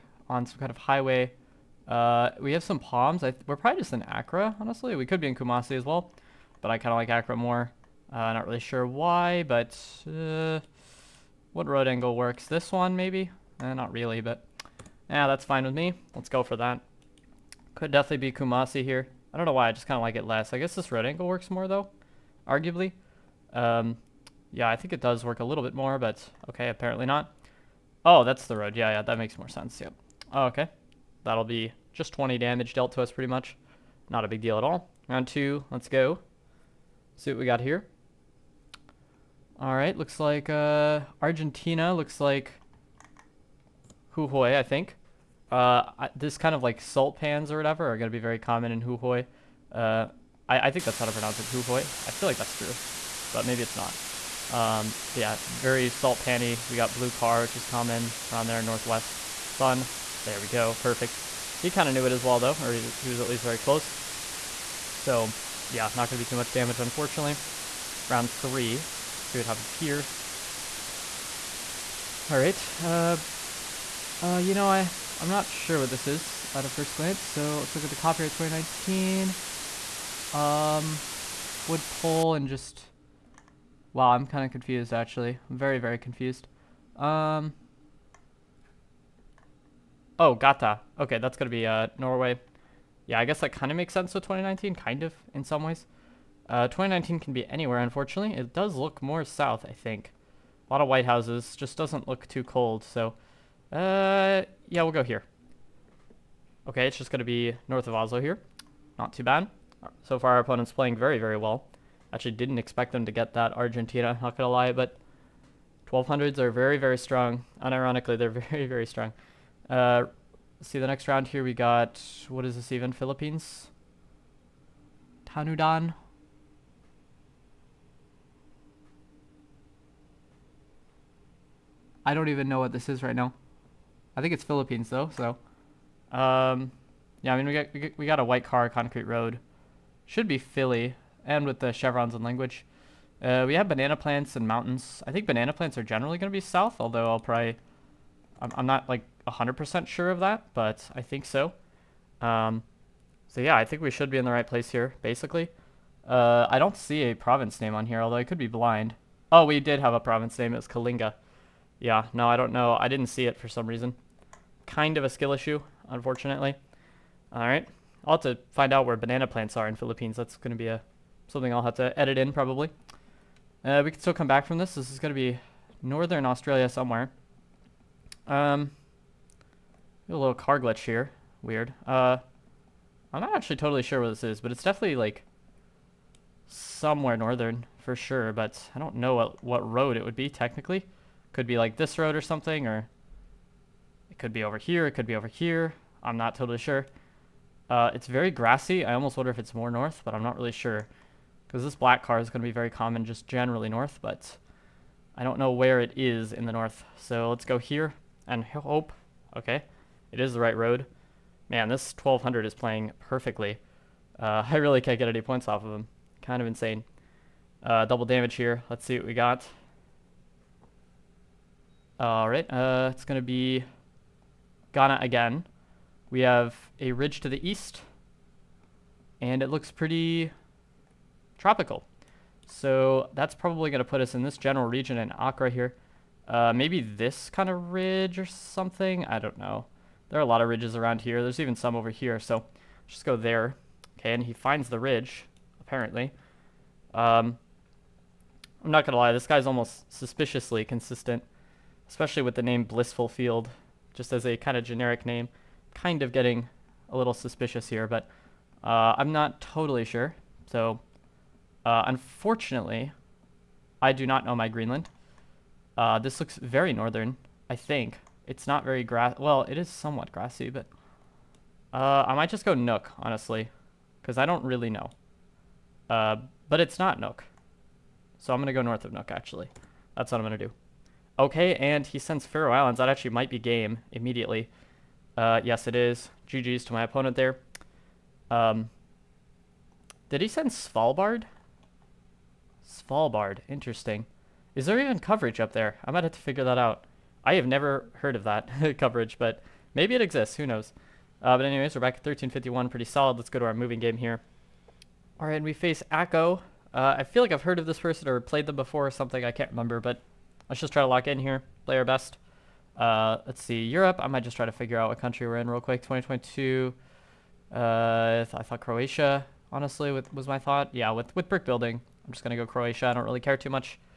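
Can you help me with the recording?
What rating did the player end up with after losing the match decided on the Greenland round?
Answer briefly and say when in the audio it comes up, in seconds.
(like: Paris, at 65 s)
1351, at 302 s.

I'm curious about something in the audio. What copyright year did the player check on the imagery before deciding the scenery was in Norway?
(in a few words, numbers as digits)
2019.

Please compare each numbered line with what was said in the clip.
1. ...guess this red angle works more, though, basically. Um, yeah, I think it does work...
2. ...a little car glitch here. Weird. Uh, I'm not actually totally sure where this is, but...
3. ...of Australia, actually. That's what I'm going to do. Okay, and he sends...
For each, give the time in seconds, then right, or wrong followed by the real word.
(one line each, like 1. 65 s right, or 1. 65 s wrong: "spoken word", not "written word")
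1. 20 s wrong: "arguably", not "basically"
2. 180 s right
3. 278 s wrong: "Nuuk", not "Australia".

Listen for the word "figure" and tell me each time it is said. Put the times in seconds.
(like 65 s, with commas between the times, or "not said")
296 s, 314 s.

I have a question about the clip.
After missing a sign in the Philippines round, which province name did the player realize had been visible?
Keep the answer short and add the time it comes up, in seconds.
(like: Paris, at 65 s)
Kalinga, at 160 s.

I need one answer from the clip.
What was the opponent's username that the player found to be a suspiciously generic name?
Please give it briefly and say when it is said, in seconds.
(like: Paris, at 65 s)
Blissful Field, at 252 s.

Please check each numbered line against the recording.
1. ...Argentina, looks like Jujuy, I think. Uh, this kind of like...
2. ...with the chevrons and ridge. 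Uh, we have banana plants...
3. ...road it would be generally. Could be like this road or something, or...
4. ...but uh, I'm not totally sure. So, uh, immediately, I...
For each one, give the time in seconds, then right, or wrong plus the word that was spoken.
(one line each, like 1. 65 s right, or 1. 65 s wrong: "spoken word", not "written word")
1. 41 s right
2. 141 s wrong: "language", not "ridge"
3. 189 s wrong: "technically", not "generally"
4. 257 s wrong: "unfortunately", not "immediately".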